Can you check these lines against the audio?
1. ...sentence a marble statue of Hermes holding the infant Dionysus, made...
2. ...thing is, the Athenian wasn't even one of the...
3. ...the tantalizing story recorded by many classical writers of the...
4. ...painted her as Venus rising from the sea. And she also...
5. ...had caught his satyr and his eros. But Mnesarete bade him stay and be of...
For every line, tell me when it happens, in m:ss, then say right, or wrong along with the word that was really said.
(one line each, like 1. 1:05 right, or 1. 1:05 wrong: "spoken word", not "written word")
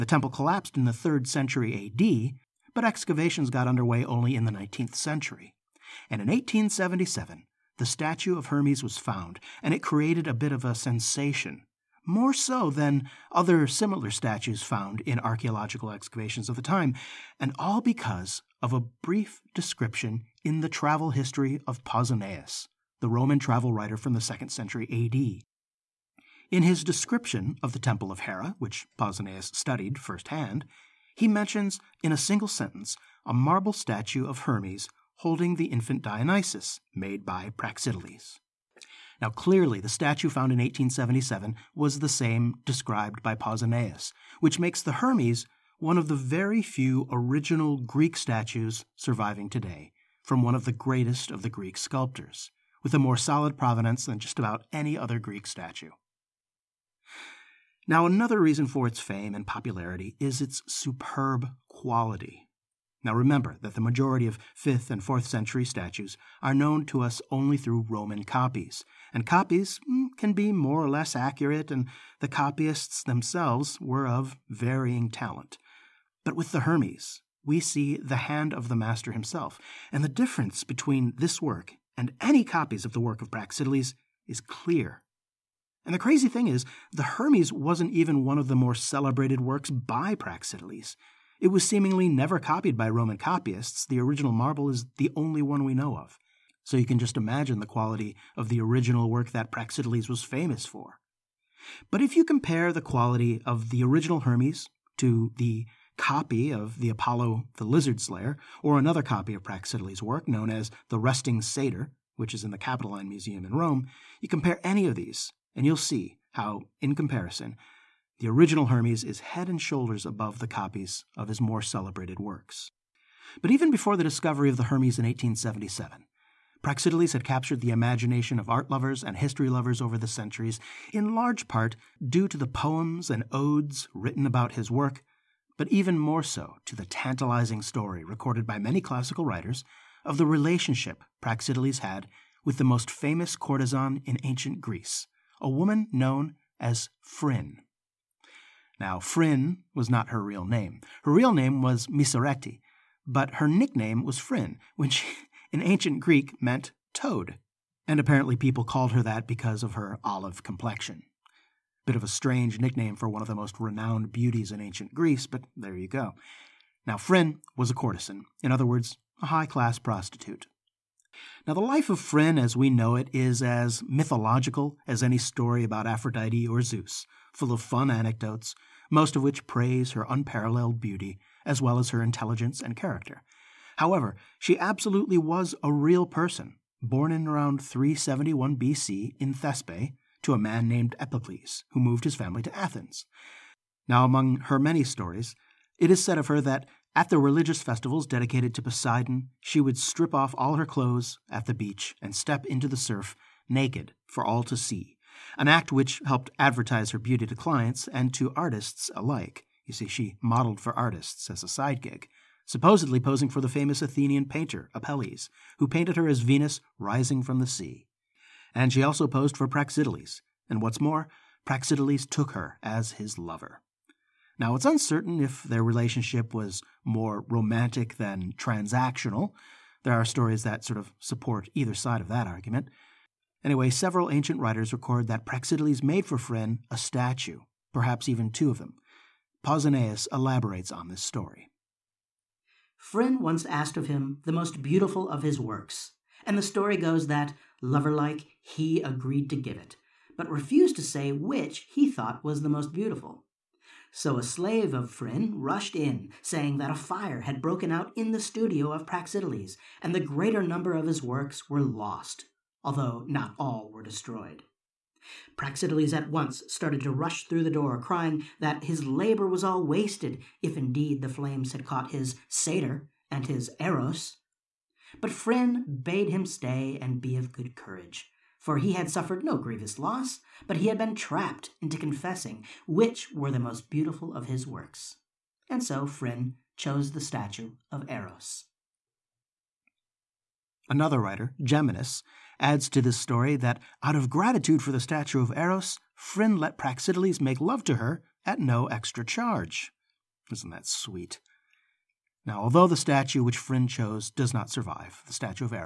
1. 0:32 right
2. 1:26 wrong: "Hermes", not "Athenian"
3. 2:16 right
4. 3:35 right
5. 4:31 wrong: "Phryne", not "Mnesarete".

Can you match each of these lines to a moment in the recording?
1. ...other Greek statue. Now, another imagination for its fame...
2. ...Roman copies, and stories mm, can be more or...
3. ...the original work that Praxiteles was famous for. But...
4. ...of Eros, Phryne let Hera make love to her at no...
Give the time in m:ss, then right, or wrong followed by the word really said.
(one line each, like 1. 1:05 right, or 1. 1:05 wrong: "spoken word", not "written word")
1. 0:54 wrong: "reason", not "imagination"
2. 1:07 wrong: "copies", not "stories"
3. 1:38 right
4. 4:55 wrong: "Praxiteles", not "Hera".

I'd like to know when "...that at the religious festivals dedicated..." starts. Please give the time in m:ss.
3:16.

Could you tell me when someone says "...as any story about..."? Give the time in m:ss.
2:54.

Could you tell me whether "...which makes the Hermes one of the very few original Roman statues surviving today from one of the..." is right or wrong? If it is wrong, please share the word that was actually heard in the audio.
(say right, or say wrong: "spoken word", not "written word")
wrong: "Greek", not "Roman".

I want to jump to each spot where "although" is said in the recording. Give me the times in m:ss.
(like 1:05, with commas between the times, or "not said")
4:22, 5:02.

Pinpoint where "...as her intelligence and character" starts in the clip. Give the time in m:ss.
3:01.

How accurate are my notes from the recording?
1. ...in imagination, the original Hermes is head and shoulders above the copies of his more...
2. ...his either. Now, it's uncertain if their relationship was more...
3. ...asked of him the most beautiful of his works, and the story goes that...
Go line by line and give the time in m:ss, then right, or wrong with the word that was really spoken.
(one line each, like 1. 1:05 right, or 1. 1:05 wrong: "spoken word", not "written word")
1. 1:56 wrong: "comparison", not "imagination"
2. 3:42 wrong: "lover", not "either"
3. 4:03 right.